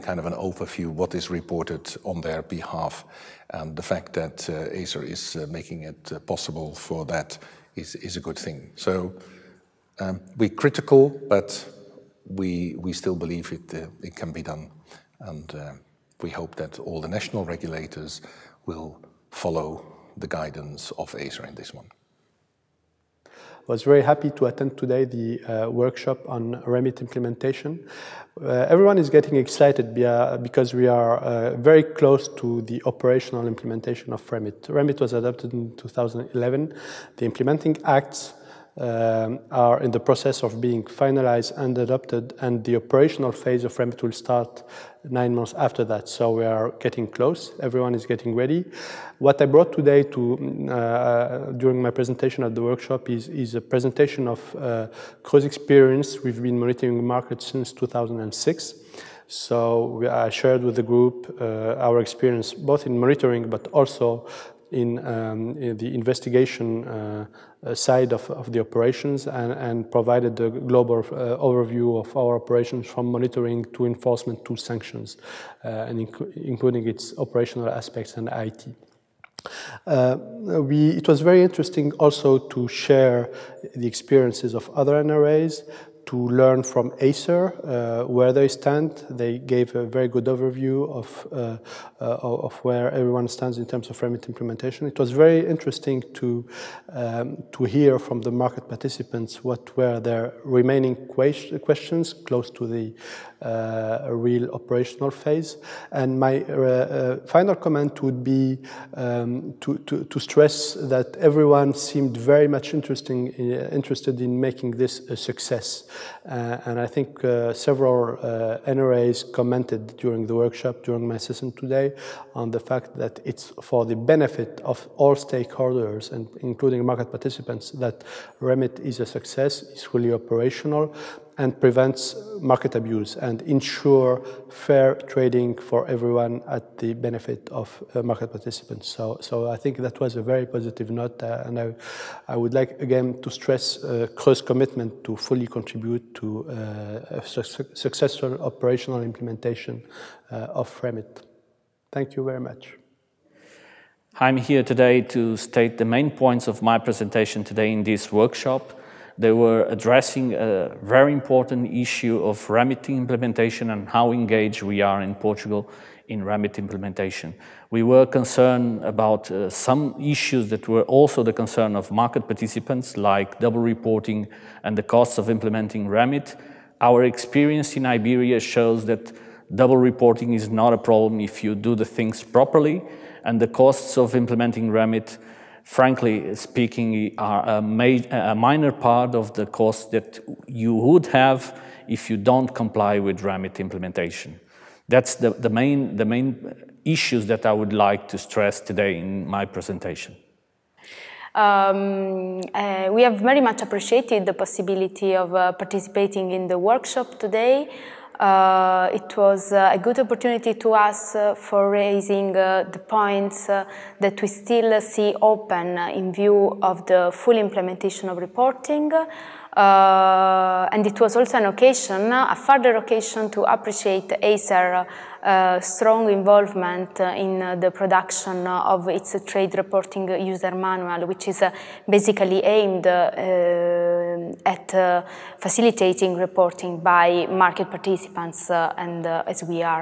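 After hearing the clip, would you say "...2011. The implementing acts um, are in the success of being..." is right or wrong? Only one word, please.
wrong.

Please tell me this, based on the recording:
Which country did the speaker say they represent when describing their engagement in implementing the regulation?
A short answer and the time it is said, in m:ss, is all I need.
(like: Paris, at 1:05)
Portugal, at 2:45.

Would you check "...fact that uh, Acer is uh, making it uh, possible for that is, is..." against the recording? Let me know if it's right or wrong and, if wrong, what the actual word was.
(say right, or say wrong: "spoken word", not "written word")
right.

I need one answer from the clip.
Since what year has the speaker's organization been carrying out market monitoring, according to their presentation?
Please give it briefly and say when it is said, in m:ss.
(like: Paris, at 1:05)
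2006, at 0:57.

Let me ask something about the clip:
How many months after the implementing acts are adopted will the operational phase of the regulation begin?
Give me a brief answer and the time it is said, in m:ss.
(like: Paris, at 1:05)
9, at 0:45.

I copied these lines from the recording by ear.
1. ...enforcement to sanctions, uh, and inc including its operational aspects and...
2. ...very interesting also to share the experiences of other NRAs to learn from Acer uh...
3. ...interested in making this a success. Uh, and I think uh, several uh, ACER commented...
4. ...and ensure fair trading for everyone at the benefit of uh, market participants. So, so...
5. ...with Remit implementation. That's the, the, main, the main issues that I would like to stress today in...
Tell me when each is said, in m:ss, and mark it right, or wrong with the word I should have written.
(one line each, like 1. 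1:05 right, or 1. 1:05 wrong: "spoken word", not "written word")
1. 1:13 right
2. 1:21 right
3. 1:53 wrong: "NRAs", not "ACER"
4. 2:13 right
5. 3:12 right.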